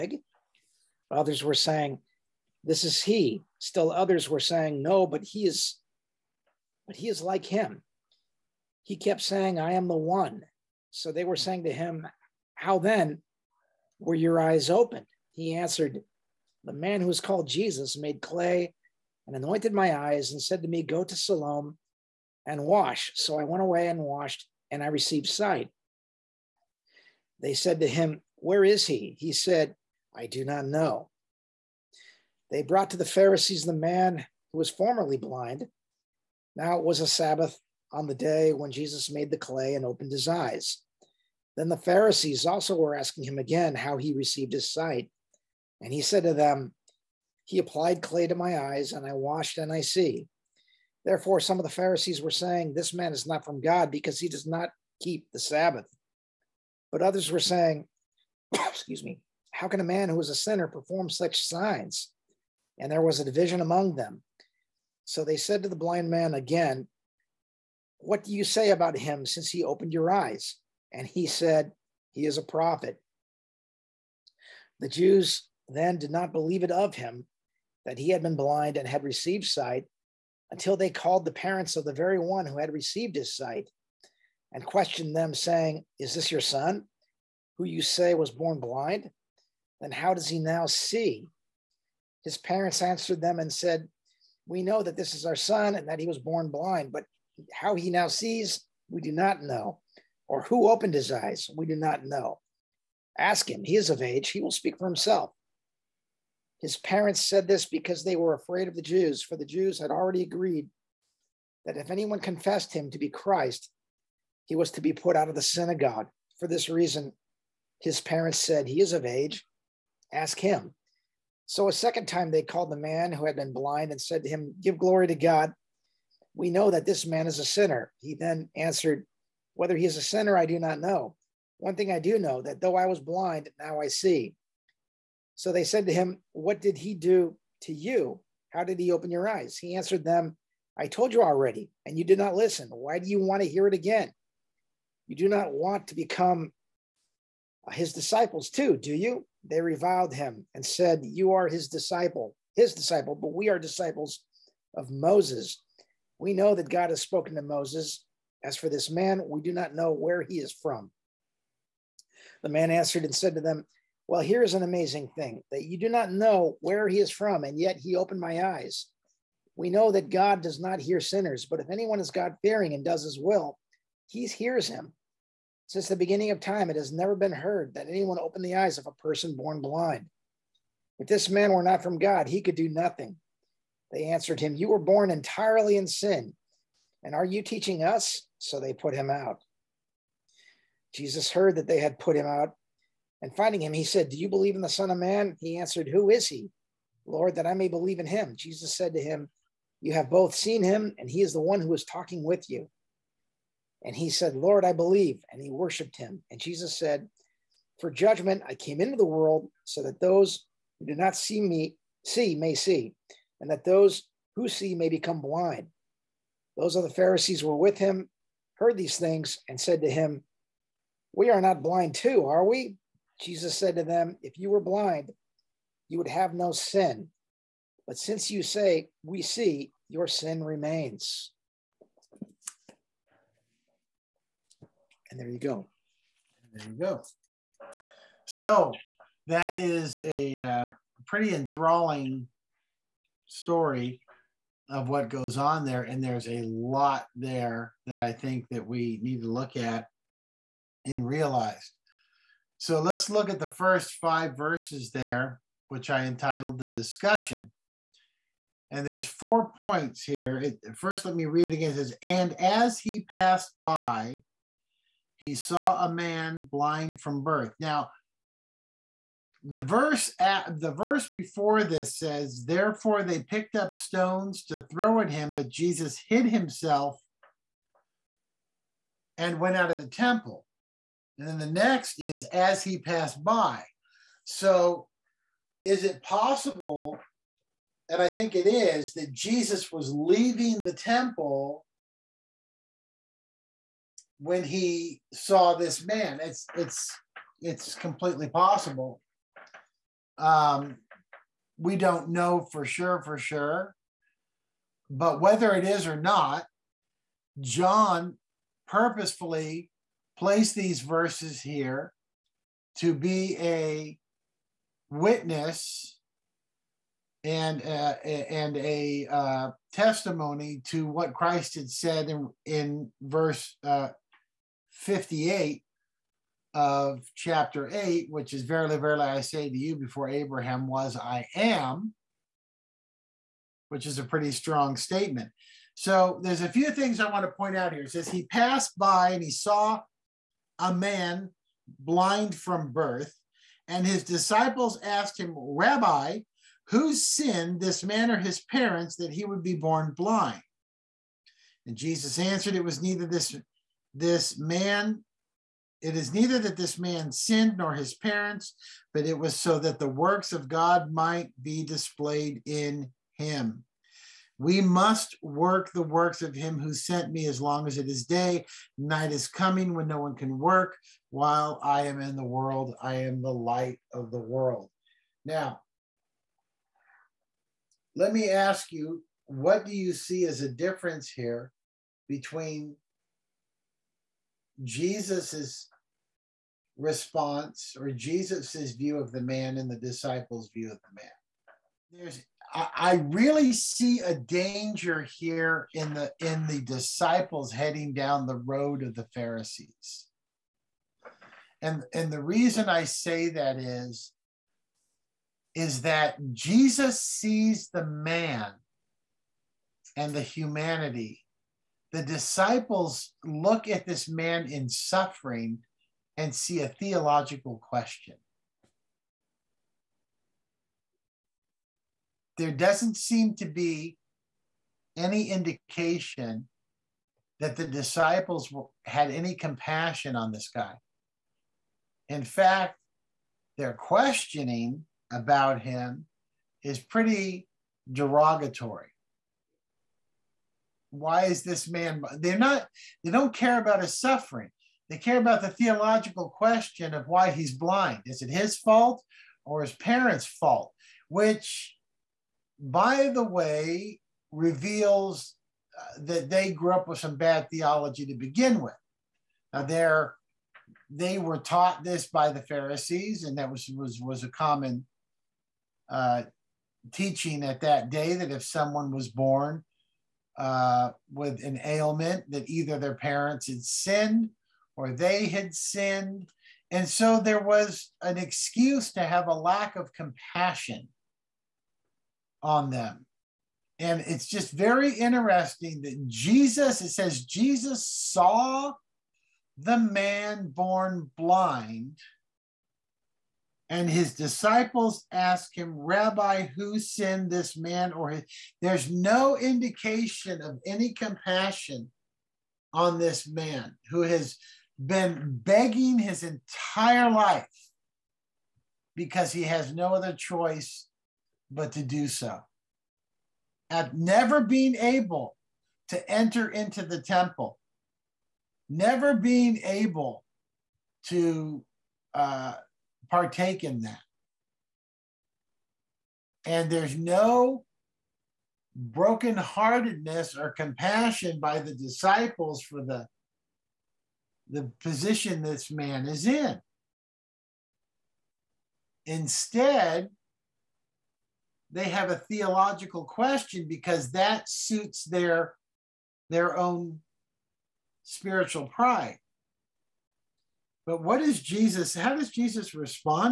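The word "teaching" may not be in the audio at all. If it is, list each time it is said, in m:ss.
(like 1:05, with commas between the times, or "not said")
3:07, 7:46.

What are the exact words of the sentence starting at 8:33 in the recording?
At never being able to enter into the temple, never being able to uh, partake in that.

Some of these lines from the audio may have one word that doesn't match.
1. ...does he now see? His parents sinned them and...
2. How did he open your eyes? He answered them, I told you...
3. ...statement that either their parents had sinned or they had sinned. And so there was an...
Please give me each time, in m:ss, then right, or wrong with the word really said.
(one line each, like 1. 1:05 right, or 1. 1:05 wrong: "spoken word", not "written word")
1. 1:30 wrong: "answered", not "sinned"
2. 2:18 right
3. 7:51 wrong: "ailment", not "statement".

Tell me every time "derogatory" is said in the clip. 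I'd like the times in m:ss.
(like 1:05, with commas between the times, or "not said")
7:17.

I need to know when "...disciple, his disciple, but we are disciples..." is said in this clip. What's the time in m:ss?
2:31.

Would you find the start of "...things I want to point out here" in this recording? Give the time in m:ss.
5:36.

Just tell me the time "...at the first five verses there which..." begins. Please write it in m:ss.
4:13.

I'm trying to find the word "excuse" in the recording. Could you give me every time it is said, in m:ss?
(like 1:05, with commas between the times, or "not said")
0:58, 7:58.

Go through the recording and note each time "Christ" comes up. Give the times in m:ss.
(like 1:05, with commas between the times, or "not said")
1:53, 5:21.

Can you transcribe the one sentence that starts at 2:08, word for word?
He then answered, Whether he is a sinner, I do not know.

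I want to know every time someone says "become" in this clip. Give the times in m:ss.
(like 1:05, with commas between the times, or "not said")
2:25, 3:34.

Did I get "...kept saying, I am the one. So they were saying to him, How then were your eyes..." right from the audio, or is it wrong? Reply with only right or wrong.
right.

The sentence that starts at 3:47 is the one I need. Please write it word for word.
But since you say, We see, your sin remains.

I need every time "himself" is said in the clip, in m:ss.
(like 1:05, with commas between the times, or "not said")
1:44, 4:36.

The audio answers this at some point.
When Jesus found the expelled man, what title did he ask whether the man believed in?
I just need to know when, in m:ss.
3:14.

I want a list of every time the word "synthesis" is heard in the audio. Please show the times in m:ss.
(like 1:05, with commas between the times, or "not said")
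not said.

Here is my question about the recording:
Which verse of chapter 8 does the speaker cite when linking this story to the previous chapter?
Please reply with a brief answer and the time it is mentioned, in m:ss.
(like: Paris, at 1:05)
58, at 5:24.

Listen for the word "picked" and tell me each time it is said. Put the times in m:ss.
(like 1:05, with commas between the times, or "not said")
4:33.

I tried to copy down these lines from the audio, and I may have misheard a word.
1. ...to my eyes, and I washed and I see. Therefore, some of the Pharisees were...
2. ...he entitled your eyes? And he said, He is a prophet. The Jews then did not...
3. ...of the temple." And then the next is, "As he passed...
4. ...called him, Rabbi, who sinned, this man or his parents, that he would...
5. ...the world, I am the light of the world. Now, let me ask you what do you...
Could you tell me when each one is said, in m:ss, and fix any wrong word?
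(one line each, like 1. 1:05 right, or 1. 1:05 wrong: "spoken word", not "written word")
1. 0:48 right
2. 1:09 wrong: "opened", not "entitled"
3. 4:39 right
4. 5:44 wrong: "asked", not "called"
5. 6:12 right.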